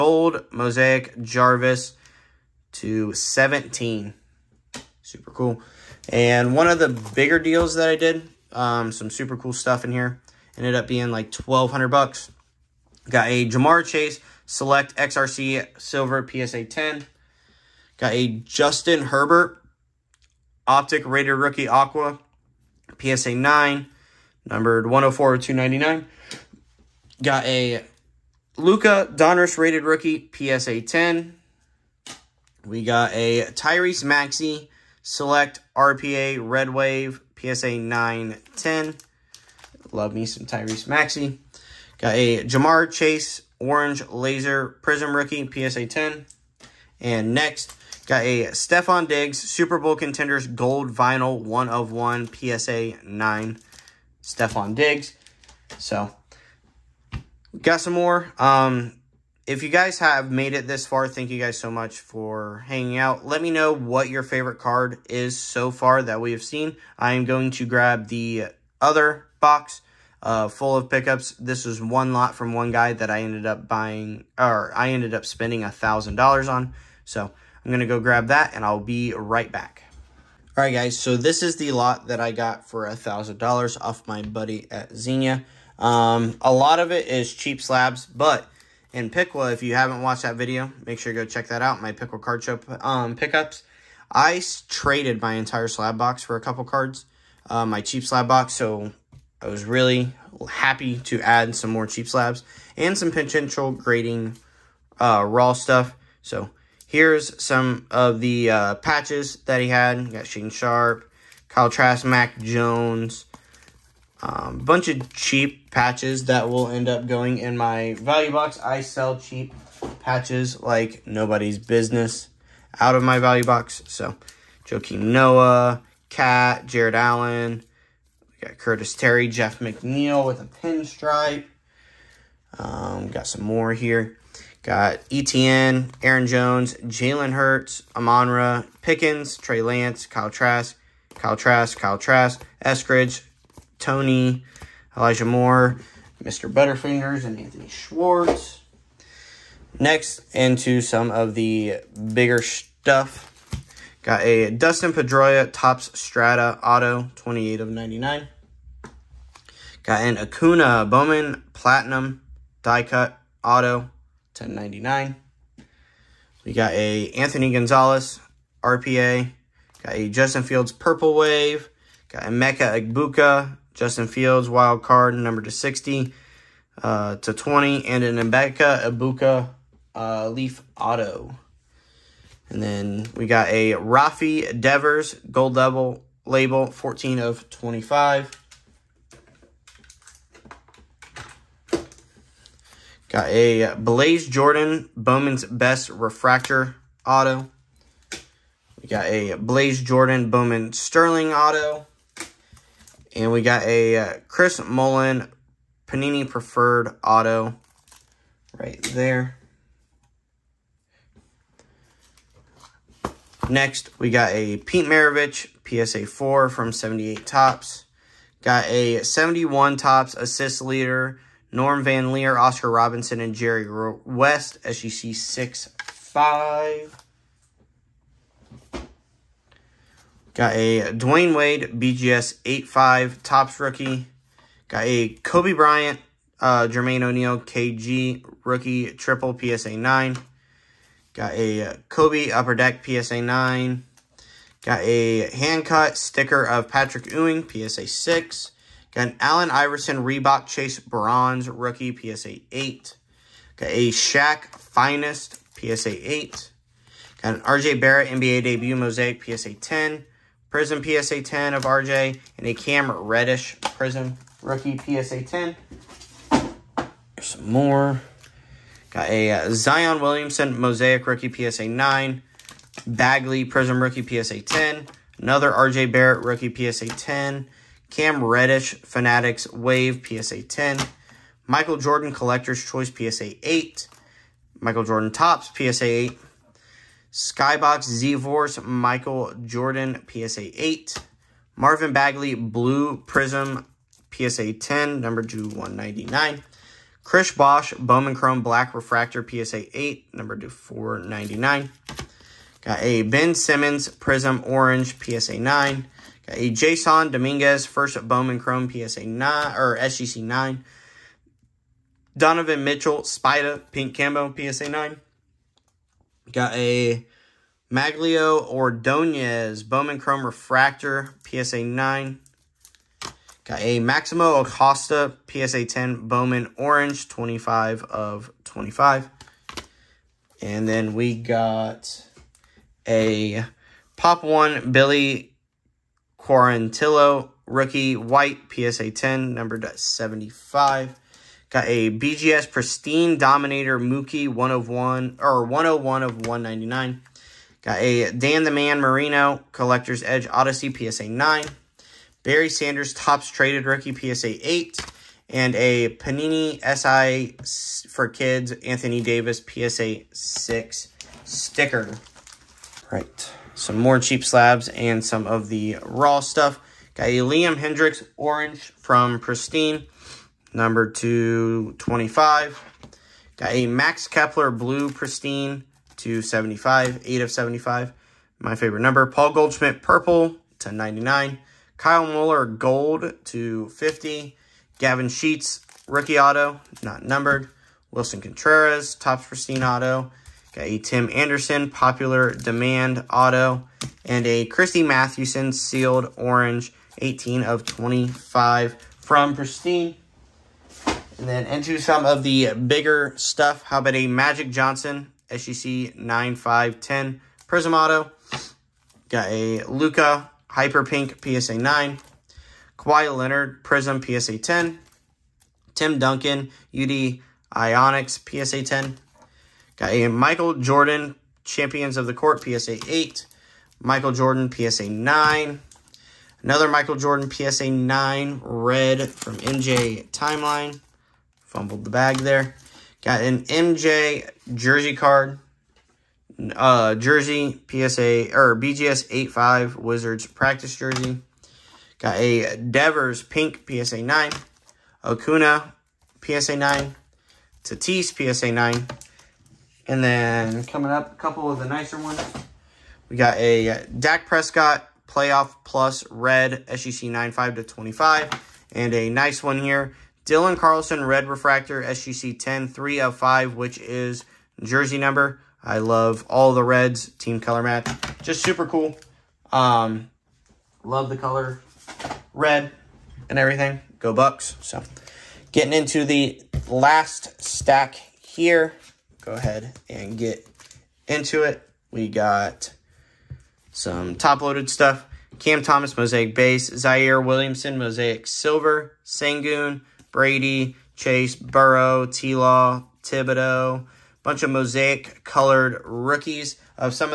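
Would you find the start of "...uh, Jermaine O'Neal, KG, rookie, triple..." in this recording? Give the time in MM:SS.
03:56.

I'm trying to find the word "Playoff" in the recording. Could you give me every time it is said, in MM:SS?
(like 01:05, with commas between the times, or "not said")
07:35.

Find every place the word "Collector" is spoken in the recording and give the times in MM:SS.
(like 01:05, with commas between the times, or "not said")
04:42, 05:49.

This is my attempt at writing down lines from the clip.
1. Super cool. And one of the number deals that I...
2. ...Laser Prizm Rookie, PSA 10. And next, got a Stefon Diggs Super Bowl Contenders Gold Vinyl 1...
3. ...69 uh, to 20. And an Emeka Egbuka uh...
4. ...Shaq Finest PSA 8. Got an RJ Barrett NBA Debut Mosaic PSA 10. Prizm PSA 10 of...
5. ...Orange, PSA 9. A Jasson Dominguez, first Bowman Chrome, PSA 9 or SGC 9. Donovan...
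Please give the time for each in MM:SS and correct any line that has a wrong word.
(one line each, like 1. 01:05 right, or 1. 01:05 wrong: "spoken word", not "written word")
1. 00:05 wrong: "bigger", not "number"
2. 00:44 right
3. 02:55 wrong: "60", not "69"
4. 04:13 right
5. 05:04 right.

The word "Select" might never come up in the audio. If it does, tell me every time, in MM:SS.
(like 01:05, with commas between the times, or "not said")
00:14, 00:35.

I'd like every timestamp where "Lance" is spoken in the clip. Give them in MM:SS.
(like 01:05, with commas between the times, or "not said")
02:19.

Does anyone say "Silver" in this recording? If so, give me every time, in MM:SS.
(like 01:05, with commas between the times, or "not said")
00:15, 08:08.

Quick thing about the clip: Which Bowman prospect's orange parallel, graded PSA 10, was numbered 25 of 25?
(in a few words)
Maximo Acosta.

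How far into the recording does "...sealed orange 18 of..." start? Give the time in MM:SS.
06:35.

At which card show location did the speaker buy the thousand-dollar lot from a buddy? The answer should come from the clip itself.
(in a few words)
Xenia.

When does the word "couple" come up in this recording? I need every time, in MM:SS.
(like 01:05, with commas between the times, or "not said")
01:36, 07:31.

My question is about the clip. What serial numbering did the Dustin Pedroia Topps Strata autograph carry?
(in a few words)
28 of 99.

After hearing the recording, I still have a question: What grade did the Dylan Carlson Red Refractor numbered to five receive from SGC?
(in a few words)
SGC 10.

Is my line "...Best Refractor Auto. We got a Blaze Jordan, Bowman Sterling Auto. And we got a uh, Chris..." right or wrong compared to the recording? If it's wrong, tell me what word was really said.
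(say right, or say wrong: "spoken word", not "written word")
right.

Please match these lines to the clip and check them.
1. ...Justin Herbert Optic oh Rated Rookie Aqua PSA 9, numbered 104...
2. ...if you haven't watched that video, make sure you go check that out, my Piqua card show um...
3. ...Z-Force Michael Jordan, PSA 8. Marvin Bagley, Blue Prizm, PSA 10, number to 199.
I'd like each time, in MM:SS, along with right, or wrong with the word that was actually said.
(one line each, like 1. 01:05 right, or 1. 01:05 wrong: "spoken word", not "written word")
1. 00:18 right
2. 01:29 right
3. 04:47 right.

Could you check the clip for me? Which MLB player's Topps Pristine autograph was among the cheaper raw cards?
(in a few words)
Willson Contreras.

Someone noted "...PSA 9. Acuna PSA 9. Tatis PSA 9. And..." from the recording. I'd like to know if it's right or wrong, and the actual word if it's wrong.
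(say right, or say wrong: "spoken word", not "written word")
right.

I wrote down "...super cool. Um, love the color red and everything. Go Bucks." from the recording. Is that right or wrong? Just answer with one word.
right.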